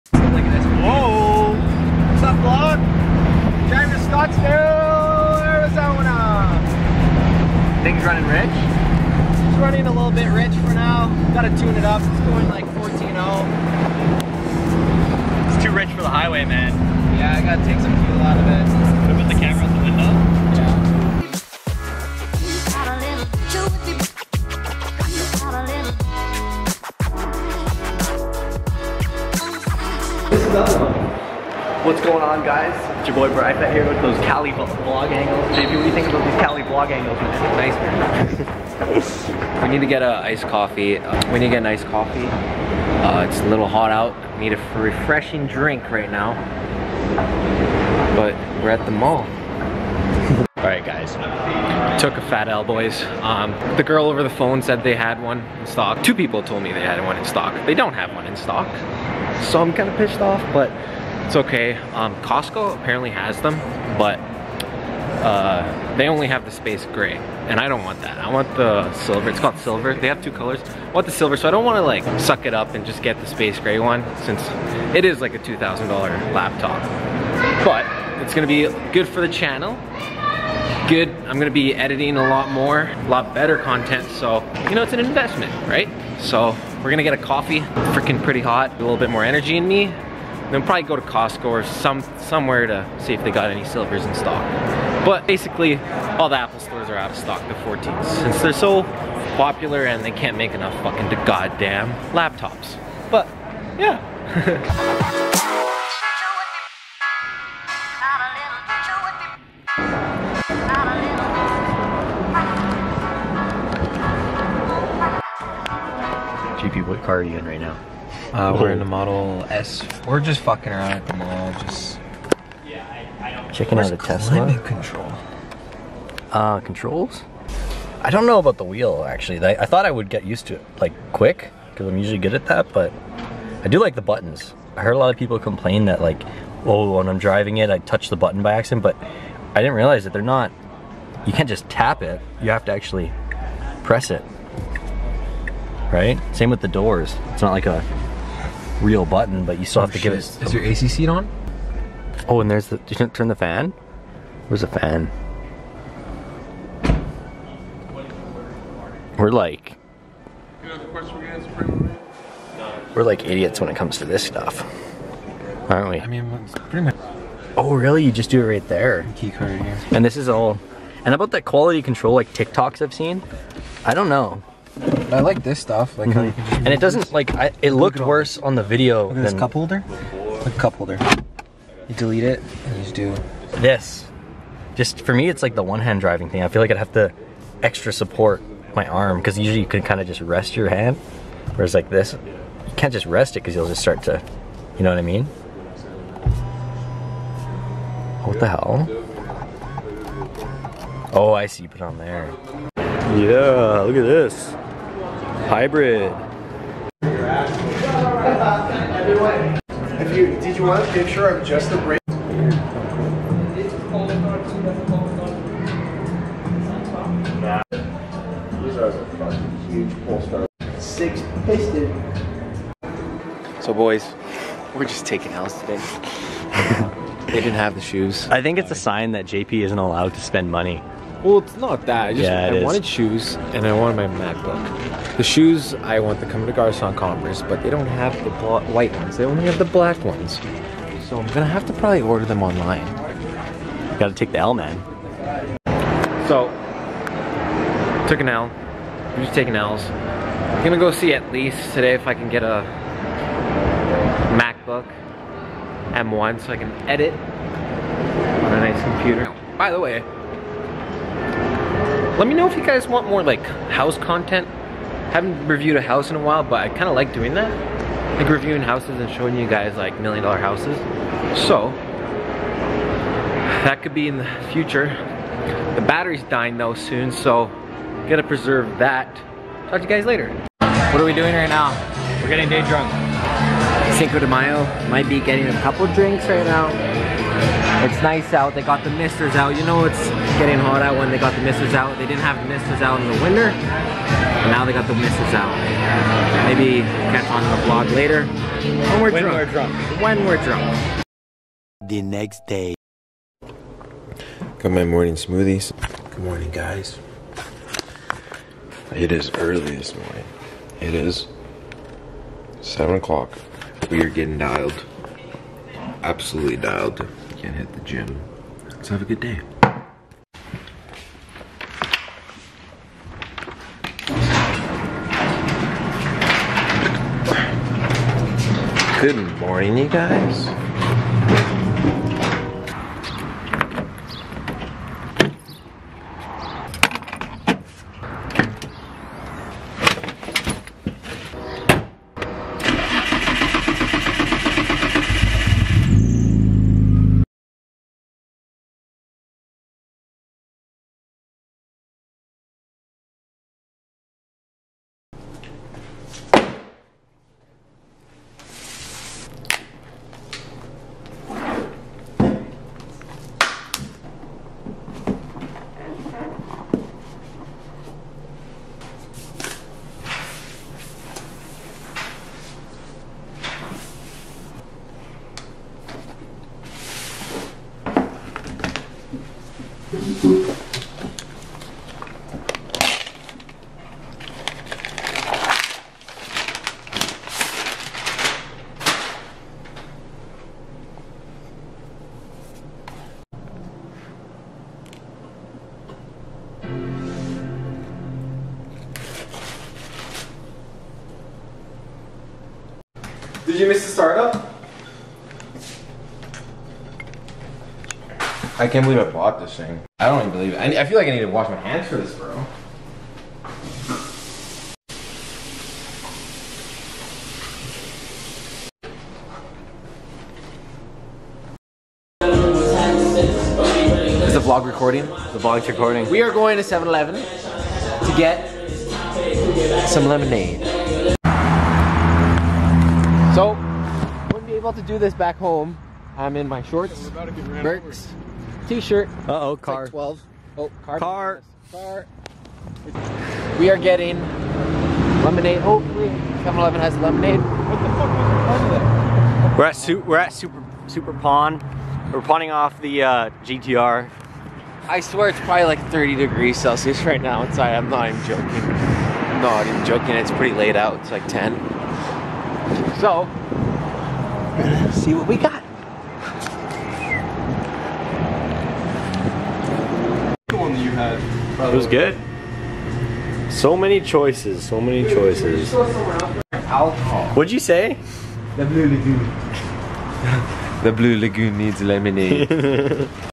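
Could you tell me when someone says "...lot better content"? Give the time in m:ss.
1:23.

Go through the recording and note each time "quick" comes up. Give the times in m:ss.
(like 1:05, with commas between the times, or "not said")
2:11.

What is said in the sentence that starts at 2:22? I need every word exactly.
You have to actually press it.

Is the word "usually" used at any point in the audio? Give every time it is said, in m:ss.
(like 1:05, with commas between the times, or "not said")
2:11, 3:09.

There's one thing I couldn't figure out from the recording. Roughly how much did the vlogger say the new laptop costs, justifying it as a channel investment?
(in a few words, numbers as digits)
$2,000.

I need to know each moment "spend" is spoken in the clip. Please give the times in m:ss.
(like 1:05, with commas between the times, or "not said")
3:50.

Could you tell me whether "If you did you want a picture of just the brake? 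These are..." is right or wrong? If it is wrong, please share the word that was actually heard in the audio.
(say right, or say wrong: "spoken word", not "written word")
right.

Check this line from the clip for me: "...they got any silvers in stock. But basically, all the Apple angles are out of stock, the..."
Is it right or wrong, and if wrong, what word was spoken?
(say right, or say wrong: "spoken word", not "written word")
wrong: "stores", not "angles".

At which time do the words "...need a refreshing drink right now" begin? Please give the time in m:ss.
0:44.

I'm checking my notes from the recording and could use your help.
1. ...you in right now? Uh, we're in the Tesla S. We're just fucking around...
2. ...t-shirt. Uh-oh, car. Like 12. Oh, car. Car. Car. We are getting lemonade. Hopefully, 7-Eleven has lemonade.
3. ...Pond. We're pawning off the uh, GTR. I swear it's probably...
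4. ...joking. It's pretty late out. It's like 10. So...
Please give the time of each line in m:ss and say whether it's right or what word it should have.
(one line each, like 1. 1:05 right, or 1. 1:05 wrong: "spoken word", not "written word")
1. 1:57 wrong: "Model", not "Tesla"
2. 7:18 right
3. 7:31 right
4. 7:39 right.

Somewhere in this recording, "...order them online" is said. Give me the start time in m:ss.
4:02.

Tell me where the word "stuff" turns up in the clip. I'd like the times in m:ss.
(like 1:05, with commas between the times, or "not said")
2:44, 2:55.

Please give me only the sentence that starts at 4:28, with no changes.
Like reviewing houses and showing you guys like million dollar houses.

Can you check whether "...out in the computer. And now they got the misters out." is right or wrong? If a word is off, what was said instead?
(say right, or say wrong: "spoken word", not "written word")
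wrong: "winter", not "computer".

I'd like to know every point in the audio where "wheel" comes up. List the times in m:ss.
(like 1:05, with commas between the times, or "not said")
2:08.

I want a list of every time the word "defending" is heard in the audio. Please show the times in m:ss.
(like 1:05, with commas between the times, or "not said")
not said.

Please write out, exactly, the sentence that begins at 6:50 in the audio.
I, I feel like I need to wash my hands for this, bro.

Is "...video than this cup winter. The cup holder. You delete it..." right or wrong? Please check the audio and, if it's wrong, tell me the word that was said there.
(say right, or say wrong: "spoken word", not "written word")
wrong: "holder", not "winter".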